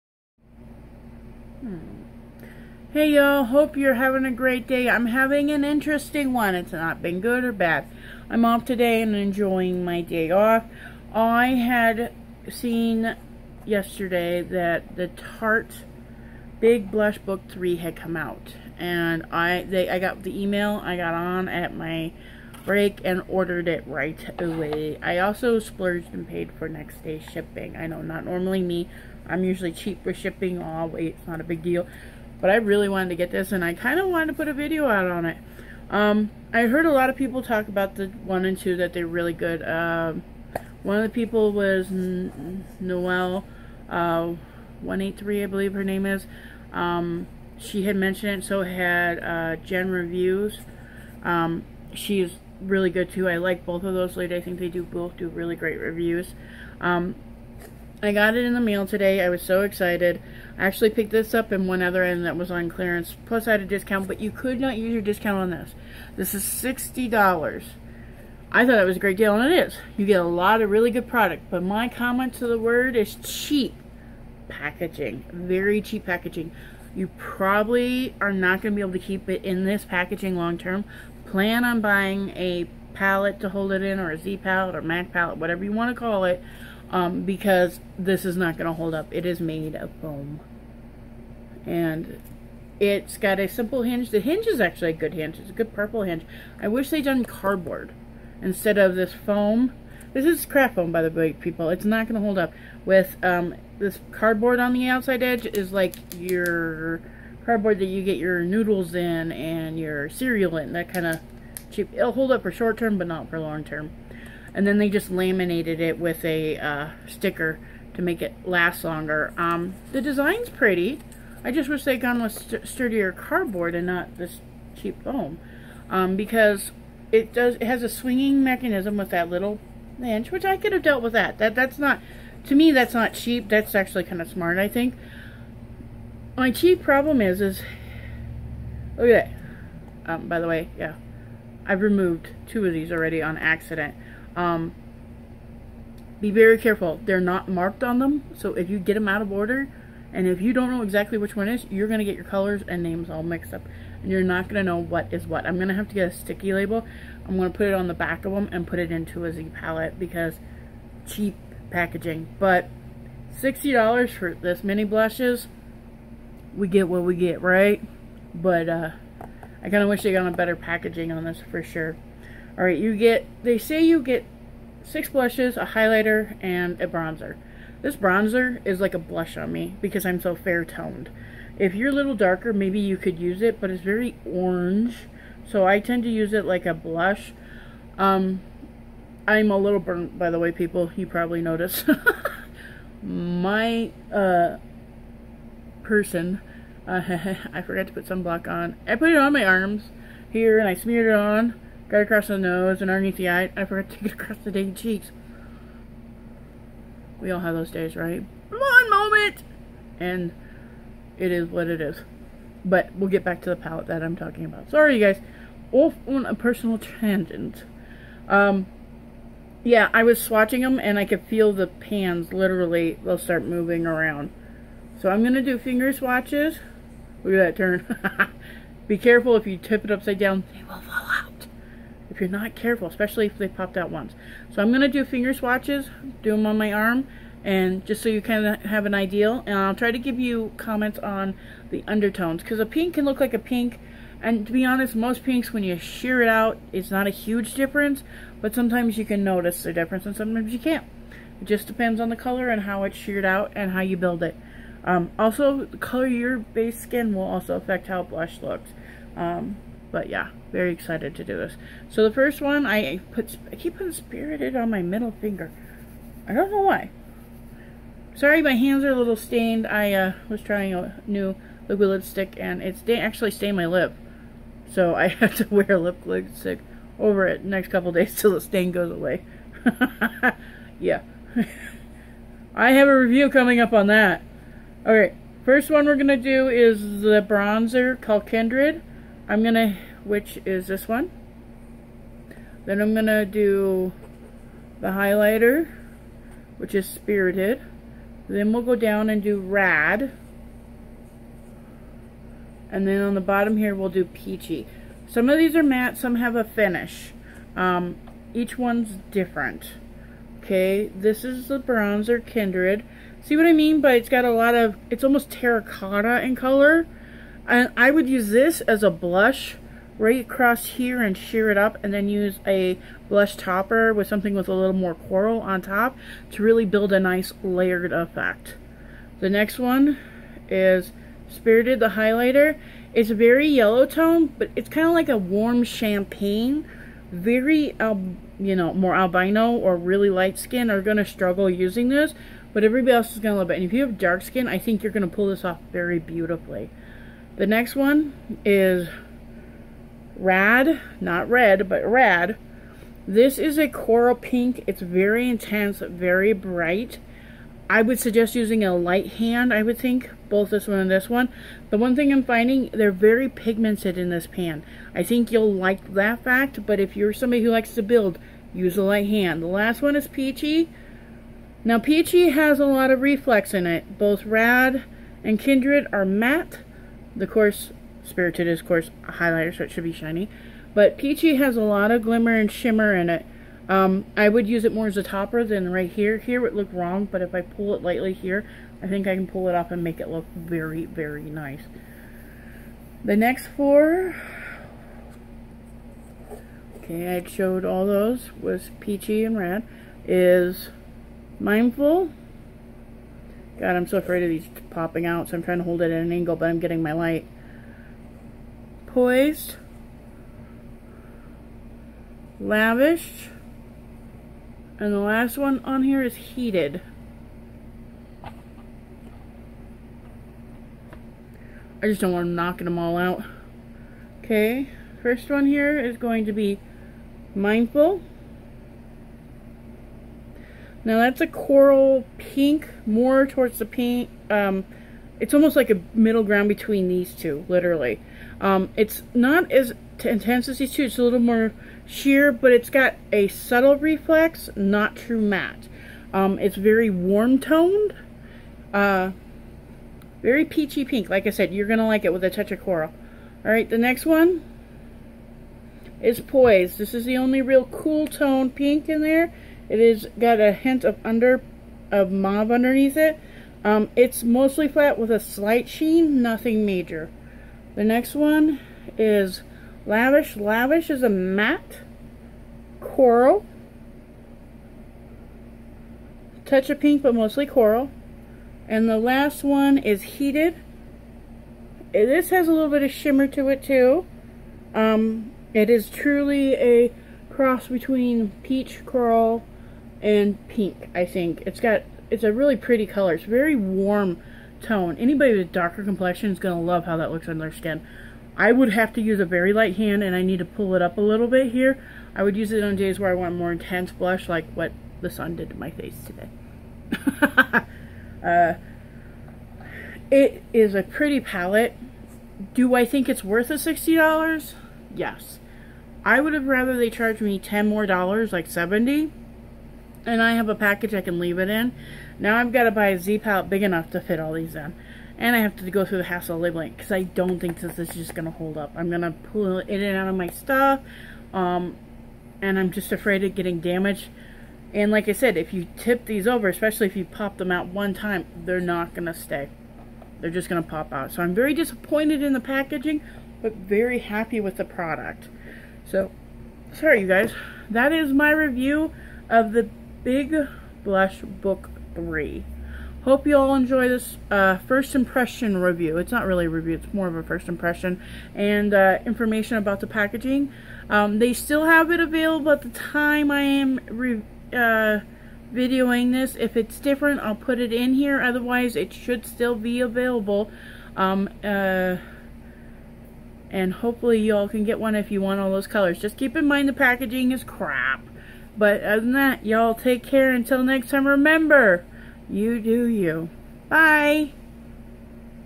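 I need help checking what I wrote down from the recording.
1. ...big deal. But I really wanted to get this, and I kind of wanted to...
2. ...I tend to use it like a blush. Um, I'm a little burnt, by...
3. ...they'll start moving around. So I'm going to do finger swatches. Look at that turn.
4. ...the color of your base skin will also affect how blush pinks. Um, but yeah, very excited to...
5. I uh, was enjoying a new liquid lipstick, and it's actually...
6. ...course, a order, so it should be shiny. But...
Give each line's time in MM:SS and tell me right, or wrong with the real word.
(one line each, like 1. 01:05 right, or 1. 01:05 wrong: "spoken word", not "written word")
1. 00:31 right
2. 03:05 right
3. 03:43 right
4. 04:15 wrong: "looks", not "pinks"
5. 04:29 wrong: "trying", not "enjoying"
6. 06:18 wrong: "highlighter", not "order".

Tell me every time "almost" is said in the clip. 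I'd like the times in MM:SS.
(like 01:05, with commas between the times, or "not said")
05:15, 07:15.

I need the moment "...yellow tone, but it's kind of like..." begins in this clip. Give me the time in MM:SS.
05:33.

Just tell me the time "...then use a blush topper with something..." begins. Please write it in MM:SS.
05:21.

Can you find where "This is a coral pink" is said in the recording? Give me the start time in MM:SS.
05:53.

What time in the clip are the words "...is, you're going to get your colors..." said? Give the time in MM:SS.
02:31.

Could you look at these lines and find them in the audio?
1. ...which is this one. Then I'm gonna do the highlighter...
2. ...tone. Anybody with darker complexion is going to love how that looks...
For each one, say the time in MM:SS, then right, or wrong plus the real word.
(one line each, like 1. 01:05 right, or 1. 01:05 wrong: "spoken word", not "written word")
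1. 04:50 right
2. 08:14 right.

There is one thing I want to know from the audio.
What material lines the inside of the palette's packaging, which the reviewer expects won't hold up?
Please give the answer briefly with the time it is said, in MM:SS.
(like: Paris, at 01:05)
craft foam, at 01:40.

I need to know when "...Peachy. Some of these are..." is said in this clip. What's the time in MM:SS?
05:04.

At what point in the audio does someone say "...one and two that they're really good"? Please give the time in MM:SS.
00:38.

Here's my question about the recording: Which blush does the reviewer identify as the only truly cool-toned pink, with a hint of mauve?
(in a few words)
Poise.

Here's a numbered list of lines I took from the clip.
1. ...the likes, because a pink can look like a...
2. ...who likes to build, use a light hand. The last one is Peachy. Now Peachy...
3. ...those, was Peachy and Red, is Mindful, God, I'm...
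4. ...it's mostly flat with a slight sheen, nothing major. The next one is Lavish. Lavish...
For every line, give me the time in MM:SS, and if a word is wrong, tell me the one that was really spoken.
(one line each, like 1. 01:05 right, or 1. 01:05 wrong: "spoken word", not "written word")
1. 04:01 wrong: "undertones", not "likes"
2. 06:07 right
3. 06:37 right
4. 07:43 right.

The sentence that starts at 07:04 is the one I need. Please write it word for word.
Okay, first one here is going to be mindful.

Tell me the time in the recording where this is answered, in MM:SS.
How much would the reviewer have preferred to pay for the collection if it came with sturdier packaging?
08:38.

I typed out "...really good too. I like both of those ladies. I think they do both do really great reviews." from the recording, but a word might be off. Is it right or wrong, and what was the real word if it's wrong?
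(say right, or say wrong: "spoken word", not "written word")
right.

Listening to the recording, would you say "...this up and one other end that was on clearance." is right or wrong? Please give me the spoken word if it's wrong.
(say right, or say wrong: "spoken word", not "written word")
right.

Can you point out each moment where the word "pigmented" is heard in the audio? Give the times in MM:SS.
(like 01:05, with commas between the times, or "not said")
06:03.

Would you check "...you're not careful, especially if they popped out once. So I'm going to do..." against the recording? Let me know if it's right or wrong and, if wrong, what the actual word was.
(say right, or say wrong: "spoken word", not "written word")
right.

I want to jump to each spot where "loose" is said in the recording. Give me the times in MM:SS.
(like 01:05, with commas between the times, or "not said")
not said.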